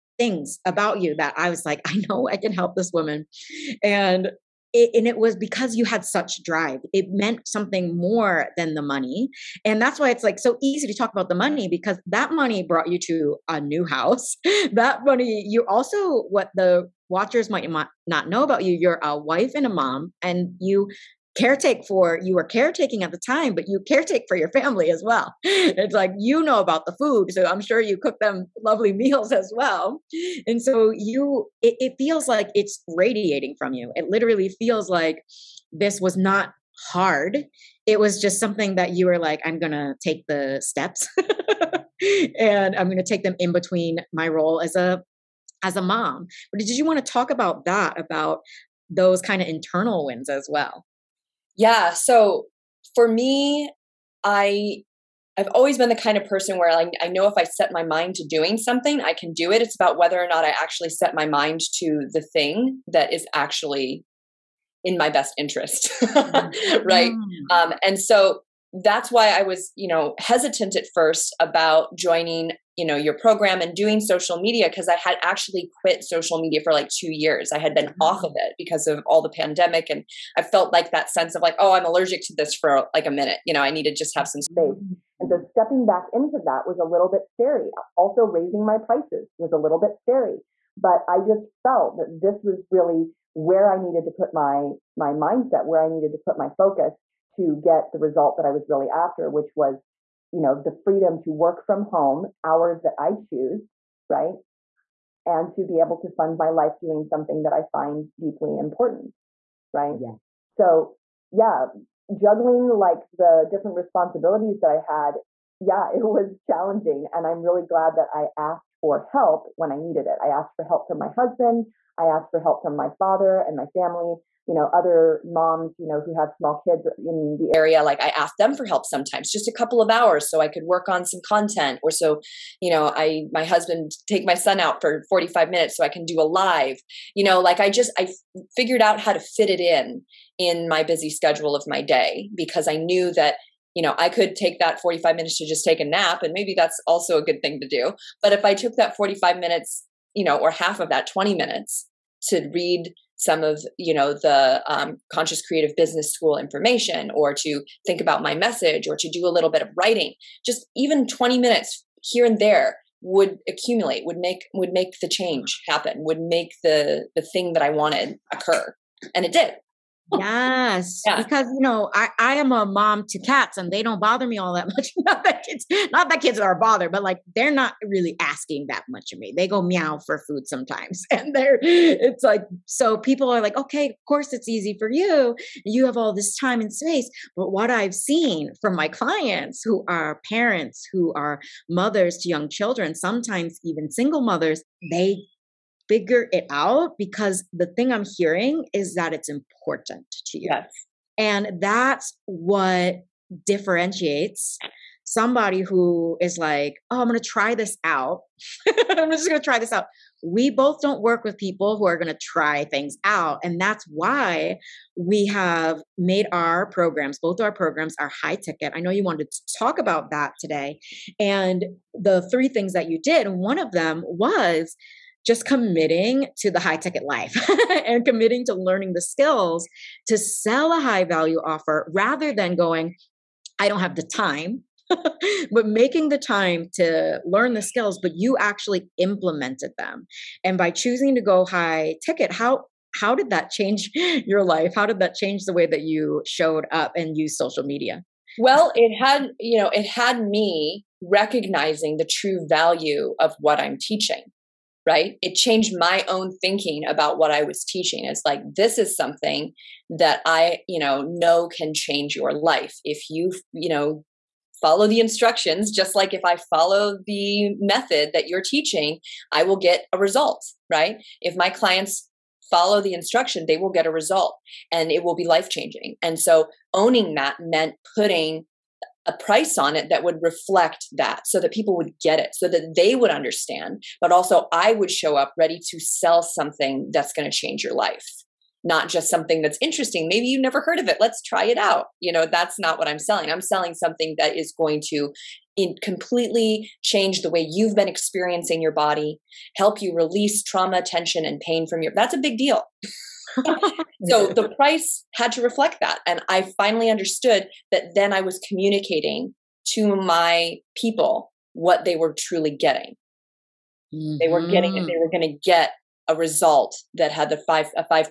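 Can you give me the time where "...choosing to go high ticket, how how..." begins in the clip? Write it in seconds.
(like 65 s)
240 s.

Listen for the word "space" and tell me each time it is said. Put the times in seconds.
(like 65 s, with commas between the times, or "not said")
84 s, 186 s.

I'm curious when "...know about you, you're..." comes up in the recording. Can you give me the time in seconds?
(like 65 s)
18 s.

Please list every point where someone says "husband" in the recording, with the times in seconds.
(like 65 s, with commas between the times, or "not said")
121 s, 133 s.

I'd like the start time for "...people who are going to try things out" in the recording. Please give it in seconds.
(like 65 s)
211 s.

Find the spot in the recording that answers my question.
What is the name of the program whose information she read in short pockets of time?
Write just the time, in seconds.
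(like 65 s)
155 s.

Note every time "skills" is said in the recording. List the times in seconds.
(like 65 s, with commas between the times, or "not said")
229 s, 237 s.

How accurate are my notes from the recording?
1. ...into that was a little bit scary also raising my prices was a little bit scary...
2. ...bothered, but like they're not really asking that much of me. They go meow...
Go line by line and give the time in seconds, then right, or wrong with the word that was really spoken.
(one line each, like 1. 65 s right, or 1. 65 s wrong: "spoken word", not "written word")
1. 86 s right
2. 176 s right.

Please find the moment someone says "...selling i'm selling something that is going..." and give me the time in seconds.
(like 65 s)
292 s.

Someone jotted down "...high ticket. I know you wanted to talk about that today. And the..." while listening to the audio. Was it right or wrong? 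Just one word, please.
right.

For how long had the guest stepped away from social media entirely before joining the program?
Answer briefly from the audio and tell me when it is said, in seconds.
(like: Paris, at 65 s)
2 years, at 76 s.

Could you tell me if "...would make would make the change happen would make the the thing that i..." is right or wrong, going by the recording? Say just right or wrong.
right.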